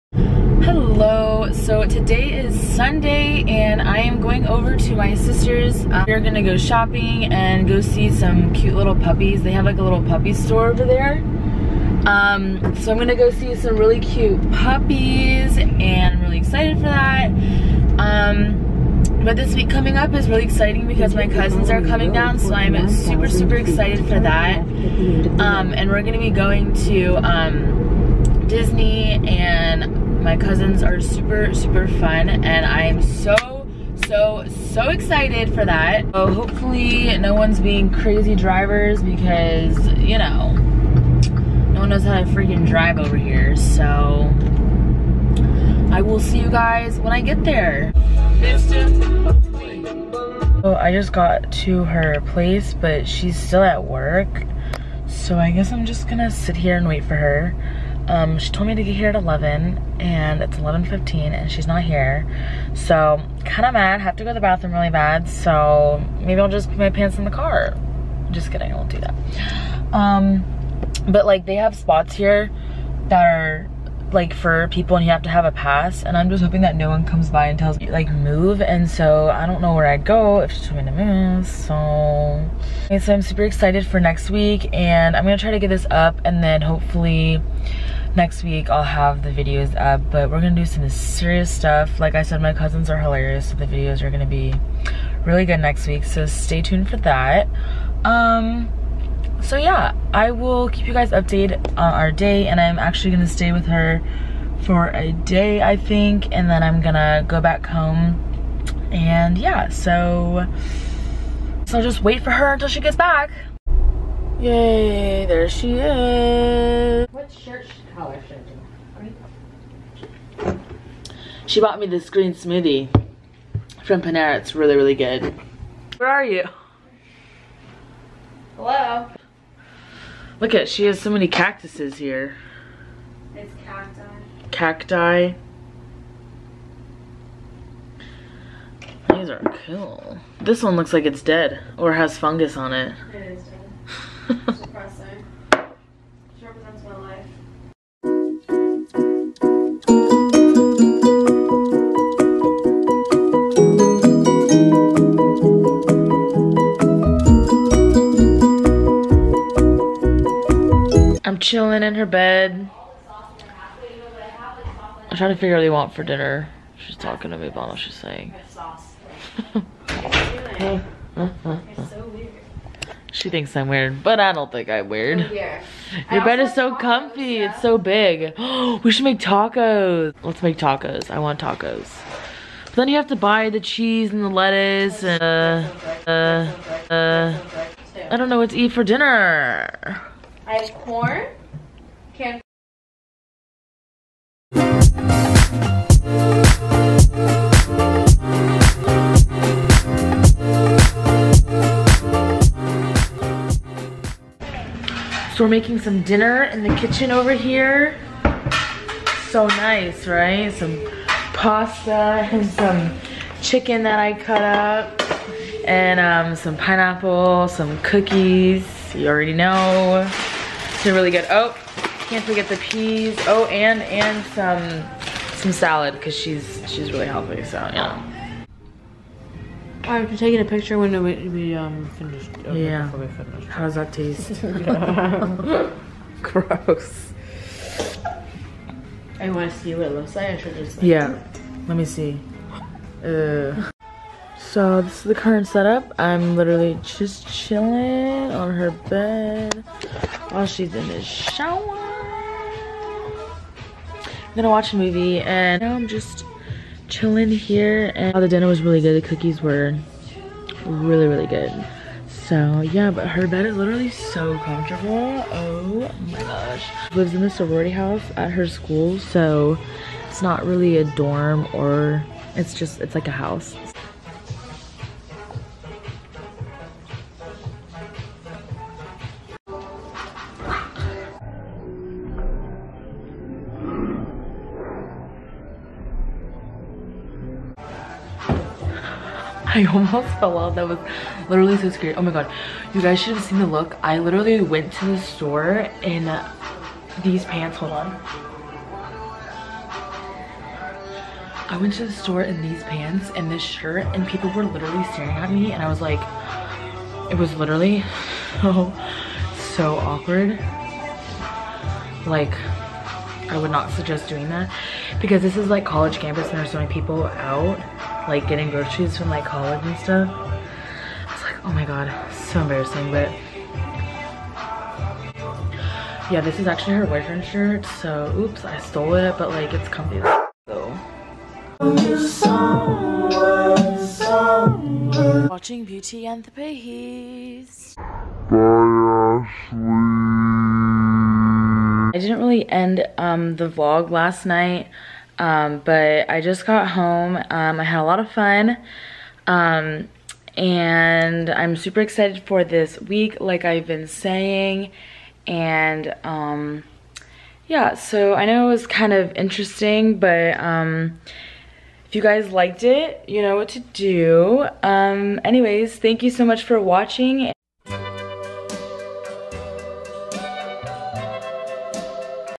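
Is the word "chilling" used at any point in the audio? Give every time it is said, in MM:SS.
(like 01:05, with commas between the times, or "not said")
02:41, 04:07, 04:16.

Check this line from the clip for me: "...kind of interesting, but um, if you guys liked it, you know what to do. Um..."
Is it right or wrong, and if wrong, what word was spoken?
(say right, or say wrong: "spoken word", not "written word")
right.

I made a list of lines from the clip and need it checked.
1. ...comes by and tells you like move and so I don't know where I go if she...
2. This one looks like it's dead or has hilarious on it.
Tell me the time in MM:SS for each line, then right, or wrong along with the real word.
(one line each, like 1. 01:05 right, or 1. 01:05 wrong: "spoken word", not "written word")
1. 01:17 right
2. 02:20 wrong: "fungus", not "hilarious".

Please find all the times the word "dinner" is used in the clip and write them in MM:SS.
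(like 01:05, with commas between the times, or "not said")
02:46, 03:08, 03:26, 04:18.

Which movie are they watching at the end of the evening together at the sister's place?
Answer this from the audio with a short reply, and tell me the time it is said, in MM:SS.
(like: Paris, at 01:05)
Beauty and the Beast, at 05:35.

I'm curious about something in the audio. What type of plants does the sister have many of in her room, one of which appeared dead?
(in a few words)
Cacti.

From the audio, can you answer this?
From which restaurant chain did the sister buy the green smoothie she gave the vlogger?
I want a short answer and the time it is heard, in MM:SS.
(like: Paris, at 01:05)
Panera, at 02:04.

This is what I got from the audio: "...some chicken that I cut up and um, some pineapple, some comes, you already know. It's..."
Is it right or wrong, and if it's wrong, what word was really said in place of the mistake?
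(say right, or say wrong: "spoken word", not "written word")
wrong: "cookies", not "comes".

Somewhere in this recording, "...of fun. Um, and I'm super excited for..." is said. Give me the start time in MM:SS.
05:47.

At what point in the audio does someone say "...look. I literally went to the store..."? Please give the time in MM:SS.
04:53.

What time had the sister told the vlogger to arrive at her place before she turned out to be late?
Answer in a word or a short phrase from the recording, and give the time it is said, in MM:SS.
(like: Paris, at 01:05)
11, at 00:59.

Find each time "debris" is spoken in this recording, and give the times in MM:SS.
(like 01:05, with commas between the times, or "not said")
not said.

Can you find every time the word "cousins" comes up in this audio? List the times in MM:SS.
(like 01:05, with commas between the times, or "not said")
00:21, 00:30, 01:32.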